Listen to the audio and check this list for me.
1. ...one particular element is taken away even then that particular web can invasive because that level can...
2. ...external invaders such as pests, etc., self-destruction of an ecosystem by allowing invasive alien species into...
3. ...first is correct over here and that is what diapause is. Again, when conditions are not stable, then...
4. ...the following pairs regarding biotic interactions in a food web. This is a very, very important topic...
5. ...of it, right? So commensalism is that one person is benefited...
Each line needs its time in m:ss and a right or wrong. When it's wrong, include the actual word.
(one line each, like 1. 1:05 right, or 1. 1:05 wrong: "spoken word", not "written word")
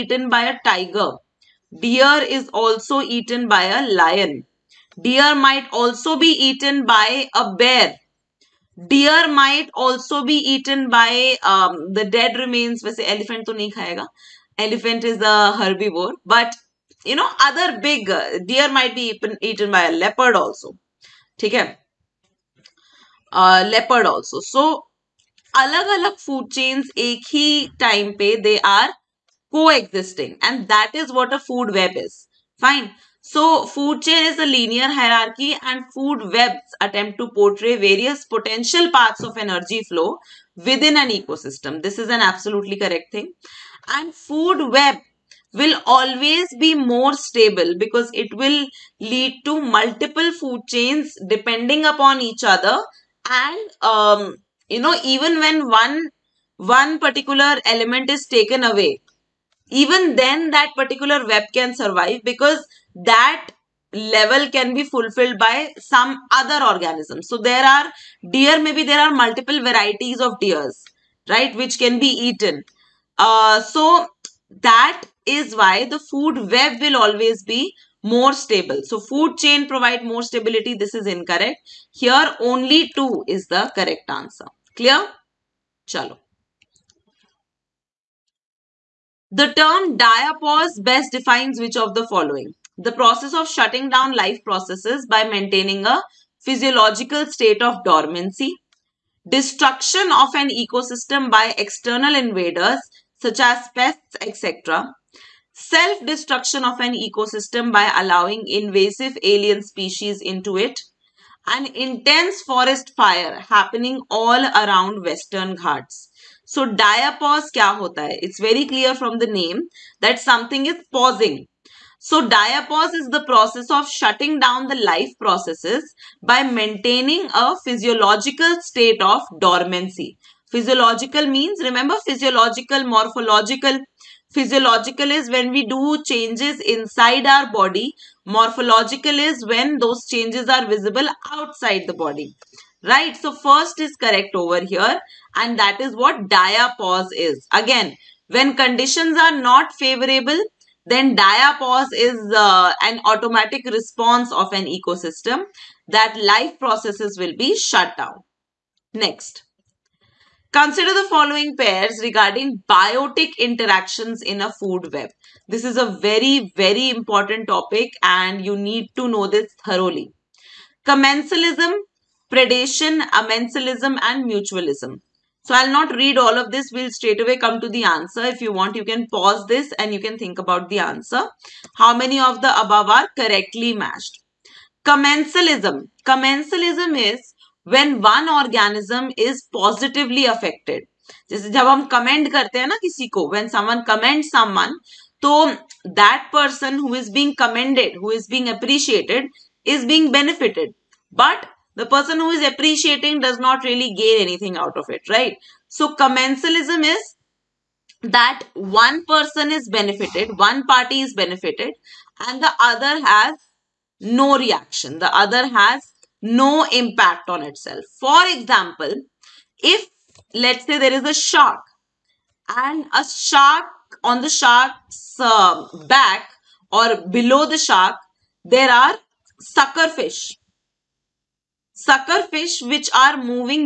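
1. 0:56 wrong: "survive", not "invasive"
2. 1:41 right
3. 2:23 wrong: "favorable", not "stable"
4. 2:40 right
5. 3:24 right.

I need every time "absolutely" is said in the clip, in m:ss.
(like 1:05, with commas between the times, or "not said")
0:42.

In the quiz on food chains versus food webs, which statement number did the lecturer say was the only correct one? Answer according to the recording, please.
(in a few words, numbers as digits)
2.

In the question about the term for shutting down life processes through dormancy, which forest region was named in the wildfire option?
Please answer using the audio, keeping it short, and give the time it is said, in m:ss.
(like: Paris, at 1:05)
Western Ghats, at 1:55.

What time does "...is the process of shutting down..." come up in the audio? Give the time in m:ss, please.
2:02.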